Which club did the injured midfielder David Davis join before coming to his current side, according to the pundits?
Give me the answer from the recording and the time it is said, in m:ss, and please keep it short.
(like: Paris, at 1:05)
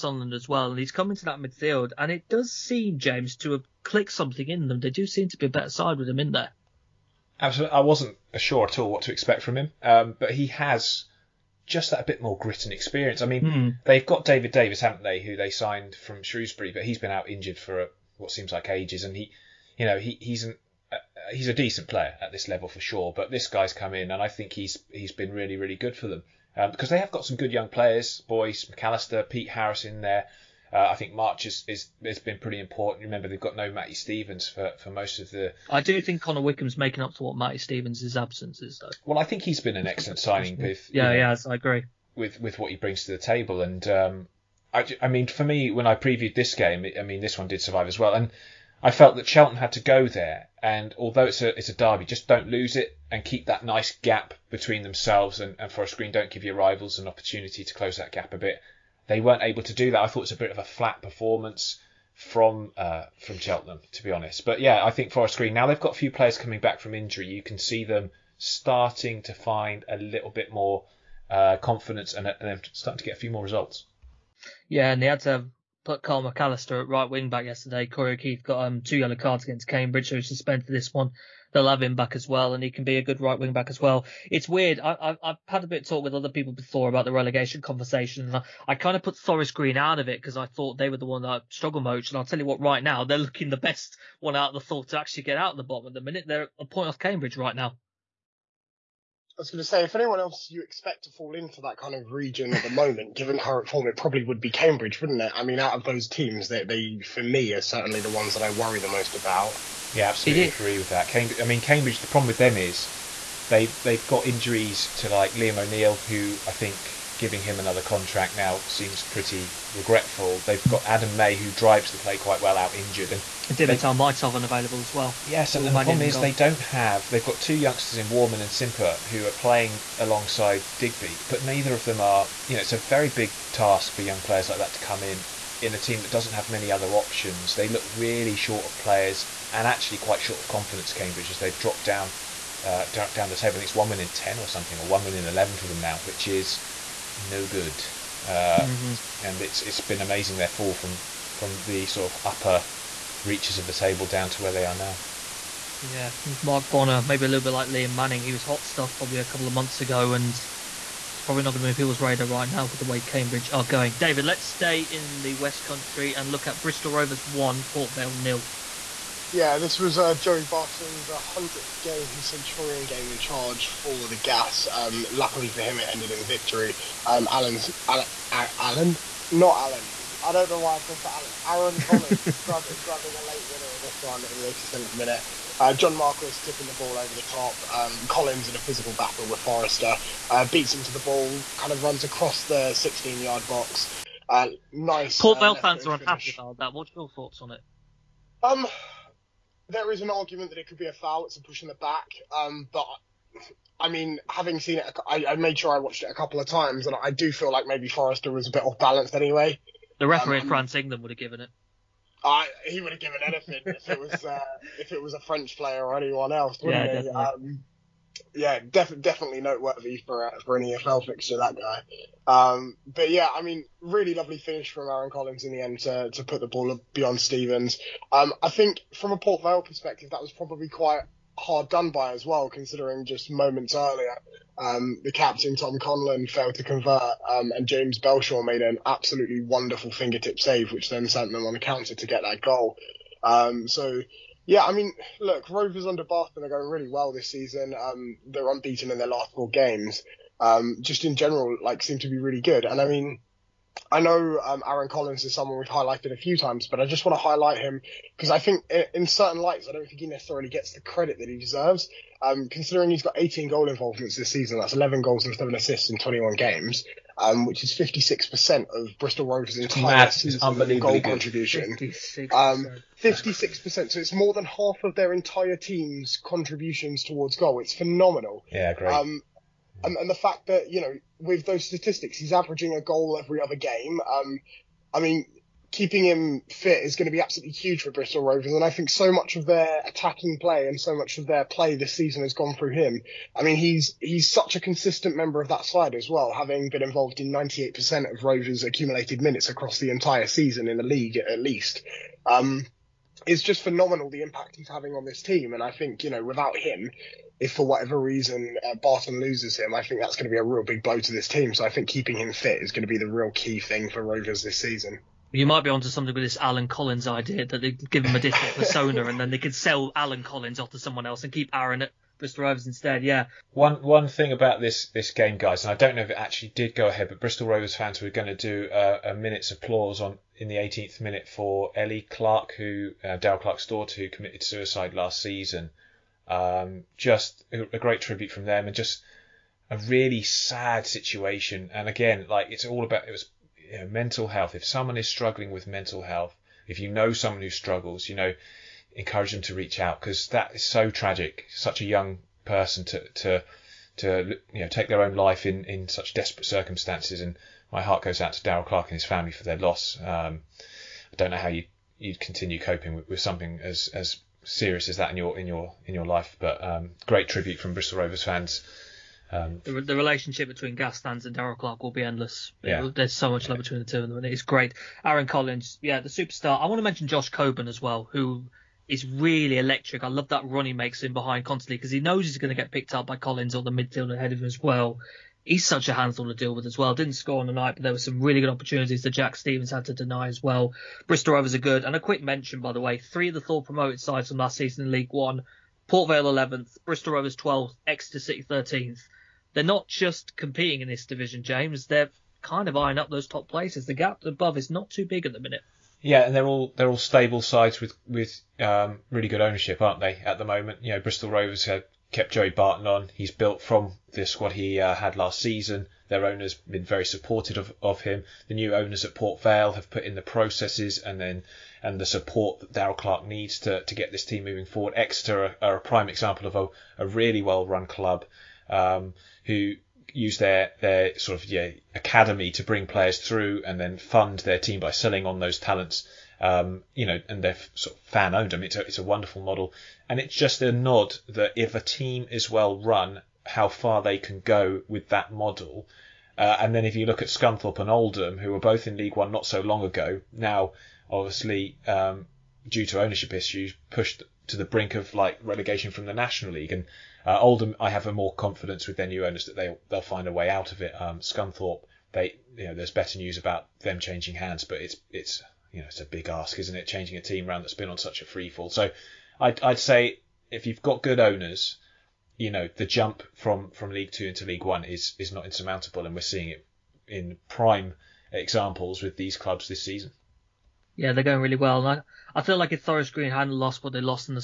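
Shrewsbury, at 0:16.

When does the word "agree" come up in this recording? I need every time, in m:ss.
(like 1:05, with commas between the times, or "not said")
0:41, 1:50.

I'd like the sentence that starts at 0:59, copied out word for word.
They weren't able to do that.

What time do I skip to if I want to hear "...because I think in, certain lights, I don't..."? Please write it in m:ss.
4:18.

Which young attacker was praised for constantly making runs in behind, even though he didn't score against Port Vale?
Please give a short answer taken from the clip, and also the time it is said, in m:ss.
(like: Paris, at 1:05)
Josh Coburn, at 6:17.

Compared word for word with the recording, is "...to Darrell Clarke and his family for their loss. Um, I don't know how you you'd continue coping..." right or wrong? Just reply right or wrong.
right.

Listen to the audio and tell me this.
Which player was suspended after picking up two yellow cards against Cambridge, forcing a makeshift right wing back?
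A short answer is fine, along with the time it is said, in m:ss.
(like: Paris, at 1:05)
Corey O'Keefe, at 1:17.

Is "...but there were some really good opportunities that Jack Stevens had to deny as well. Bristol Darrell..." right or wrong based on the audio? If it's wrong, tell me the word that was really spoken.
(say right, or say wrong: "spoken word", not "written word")
wrong: "Rovers", not "Darrell".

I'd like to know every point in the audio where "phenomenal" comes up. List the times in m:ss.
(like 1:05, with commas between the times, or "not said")
4:37, 5:03.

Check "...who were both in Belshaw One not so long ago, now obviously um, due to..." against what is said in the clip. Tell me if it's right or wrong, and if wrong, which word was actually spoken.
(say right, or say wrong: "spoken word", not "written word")
wrong: "League", not "Belshaw".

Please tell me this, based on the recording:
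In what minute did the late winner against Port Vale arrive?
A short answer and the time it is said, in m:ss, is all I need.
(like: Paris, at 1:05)
87th minute, at 3:04.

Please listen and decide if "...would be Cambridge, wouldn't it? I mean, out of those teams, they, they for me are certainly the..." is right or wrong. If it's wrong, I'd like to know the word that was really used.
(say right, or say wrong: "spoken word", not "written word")
right.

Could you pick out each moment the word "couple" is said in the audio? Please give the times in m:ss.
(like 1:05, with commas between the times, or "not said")
2:39, 3:26.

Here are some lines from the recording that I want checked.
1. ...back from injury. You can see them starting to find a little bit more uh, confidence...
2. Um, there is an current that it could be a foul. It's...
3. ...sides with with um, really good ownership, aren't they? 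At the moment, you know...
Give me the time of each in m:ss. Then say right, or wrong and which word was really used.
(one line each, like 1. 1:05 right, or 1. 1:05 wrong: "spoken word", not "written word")
1. 1:06 right
2. 3:18 wrong: "argument", not "current"
3. 6:47 right.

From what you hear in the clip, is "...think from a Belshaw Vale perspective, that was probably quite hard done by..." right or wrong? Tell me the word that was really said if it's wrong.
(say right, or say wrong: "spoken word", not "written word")
wrong: "Port", not "Belshaw".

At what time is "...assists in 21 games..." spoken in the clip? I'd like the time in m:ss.
4:25.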